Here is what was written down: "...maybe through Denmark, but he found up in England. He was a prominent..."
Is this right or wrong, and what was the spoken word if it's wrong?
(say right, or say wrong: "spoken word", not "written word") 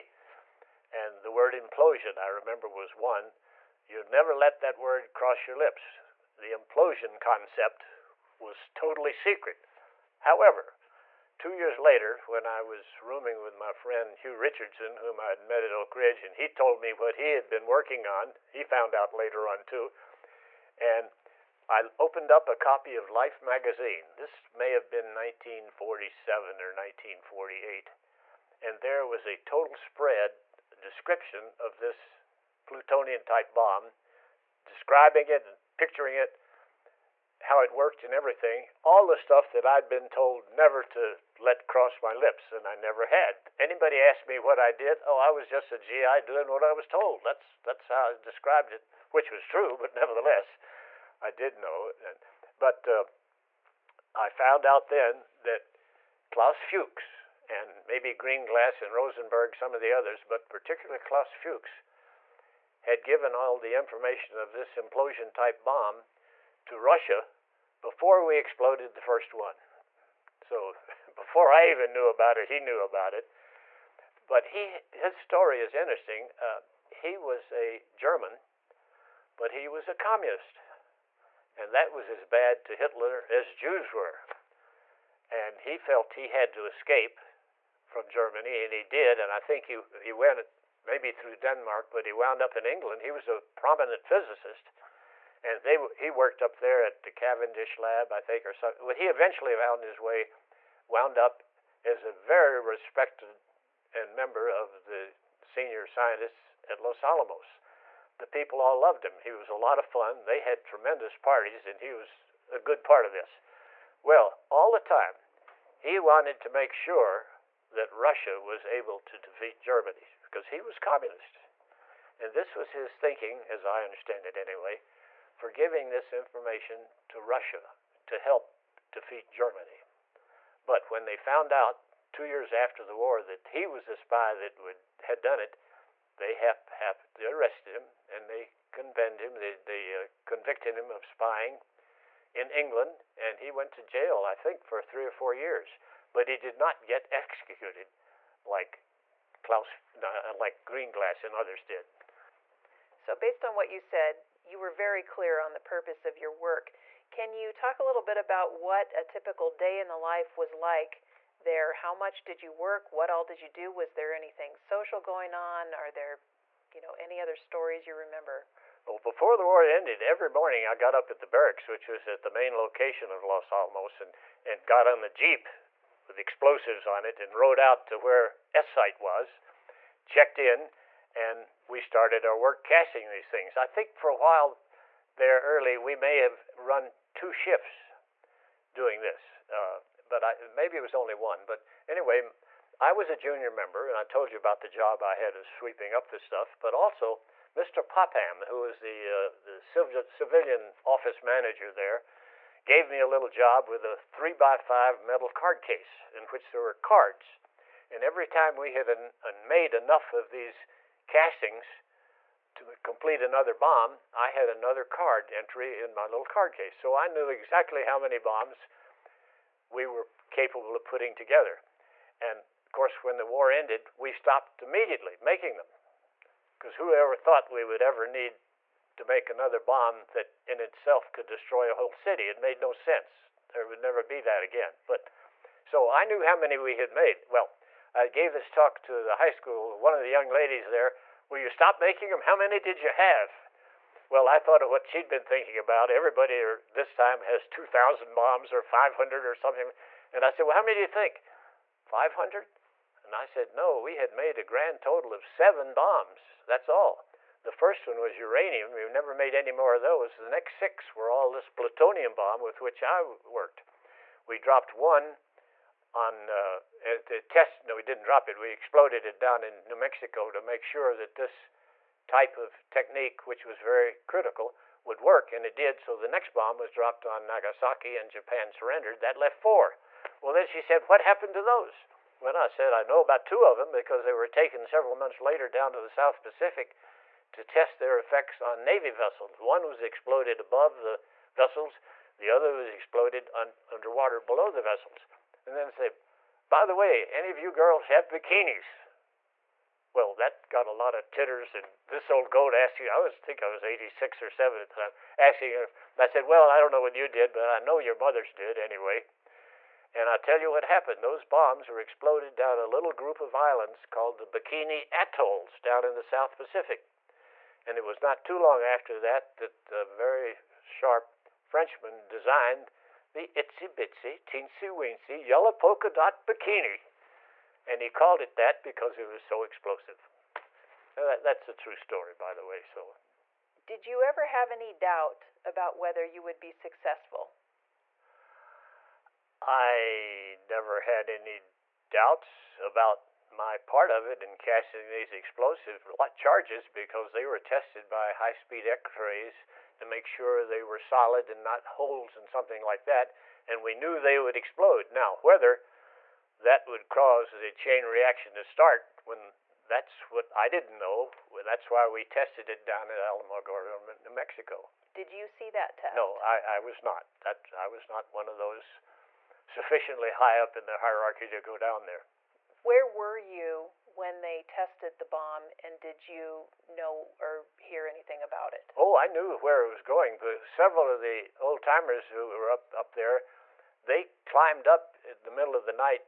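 wrong: "wound", not "found".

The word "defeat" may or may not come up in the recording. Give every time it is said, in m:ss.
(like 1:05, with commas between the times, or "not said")
1:59, 2:08.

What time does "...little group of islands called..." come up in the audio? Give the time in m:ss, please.
5:12.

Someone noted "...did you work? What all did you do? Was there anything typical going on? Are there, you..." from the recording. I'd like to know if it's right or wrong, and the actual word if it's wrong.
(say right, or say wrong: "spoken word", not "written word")
wrong: "social", not "typical".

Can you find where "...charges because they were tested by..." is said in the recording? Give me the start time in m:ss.
5:46.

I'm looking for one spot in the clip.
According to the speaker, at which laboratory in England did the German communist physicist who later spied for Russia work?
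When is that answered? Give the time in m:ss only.
1:37.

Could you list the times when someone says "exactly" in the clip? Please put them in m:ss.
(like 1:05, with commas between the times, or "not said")
3:37.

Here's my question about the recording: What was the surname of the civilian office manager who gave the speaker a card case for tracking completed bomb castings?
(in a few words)
Popham.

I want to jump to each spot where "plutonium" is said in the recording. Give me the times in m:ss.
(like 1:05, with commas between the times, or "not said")
0:32, 4:21.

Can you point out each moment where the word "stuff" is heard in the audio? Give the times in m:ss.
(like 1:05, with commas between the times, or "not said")
0:39, 3:16.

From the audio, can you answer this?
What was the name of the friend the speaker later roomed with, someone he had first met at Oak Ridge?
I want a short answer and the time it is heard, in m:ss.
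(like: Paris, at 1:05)
Hugh Richardson, at 0:14.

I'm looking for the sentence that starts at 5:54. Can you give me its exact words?
Now, whether that would cause a chain reaction to start when that's what I didn't know.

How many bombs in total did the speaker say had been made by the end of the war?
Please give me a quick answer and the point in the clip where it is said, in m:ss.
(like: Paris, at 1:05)
7, at 4:15.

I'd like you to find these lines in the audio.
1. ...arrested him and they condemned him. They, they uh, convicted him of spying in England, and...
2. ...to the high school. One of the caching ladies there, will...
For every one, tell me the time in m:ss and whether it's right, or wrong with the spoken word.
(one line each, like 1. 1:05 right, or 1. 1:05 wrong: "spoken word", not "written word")
1. 2:17 right
2. 3:58 wrong: "young", not "caching".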